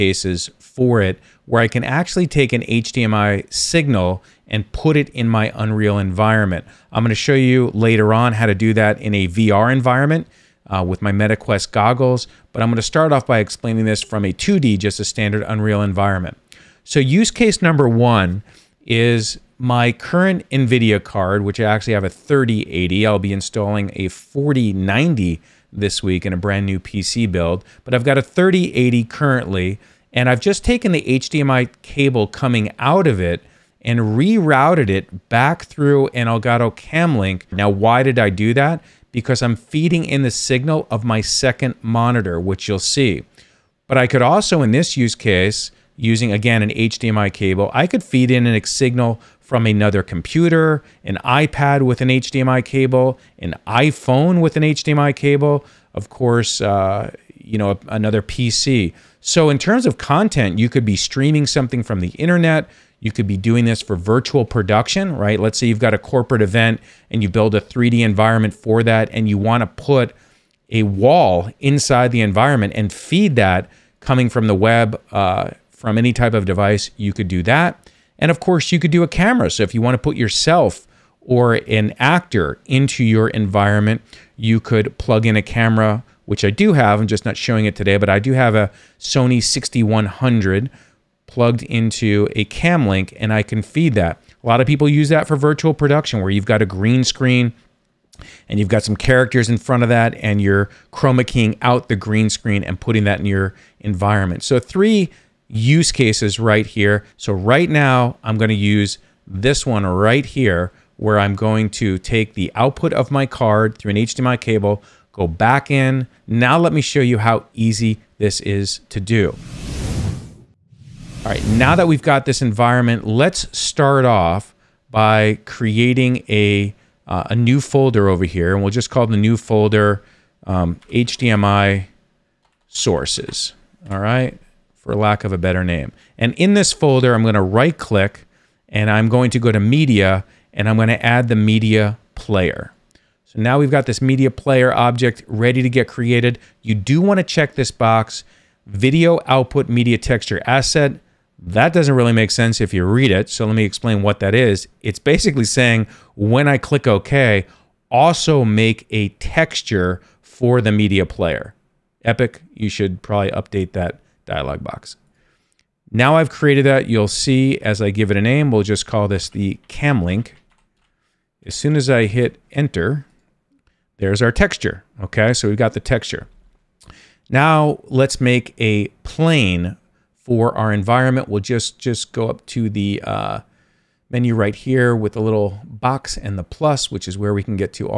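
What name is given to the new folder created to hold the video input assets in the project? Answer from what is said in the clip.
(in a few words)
HDMI sources.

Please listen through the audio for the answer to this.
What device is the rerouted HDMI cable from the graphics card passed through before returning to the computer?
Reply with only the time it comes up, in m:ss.
0:36.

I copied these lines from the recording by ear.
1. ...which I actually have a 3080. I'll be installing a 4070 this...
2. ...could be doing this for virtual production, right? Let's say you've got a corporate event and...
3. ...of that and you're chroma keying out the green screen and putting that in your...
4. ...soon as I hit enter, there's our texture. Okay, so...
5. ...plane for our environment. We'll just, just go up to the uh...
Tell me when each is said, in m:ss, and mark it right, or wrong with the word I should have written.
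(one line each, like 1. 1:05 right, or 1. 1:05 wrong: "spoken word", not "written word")
1. 0:21 wrong: "4090", not "4070"
2. 1:03 right
3. 1:39 right
4. 2:51 right
5. 2:59 right.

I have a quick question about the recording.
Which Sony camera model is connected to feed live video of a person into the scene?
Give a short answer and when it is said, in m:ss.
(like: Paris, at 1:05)
6100, at 1:28.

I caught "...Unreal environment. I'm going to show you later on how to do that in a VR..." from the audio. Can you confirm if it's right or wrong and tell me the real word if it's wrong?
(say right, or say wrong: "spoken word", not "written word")
right.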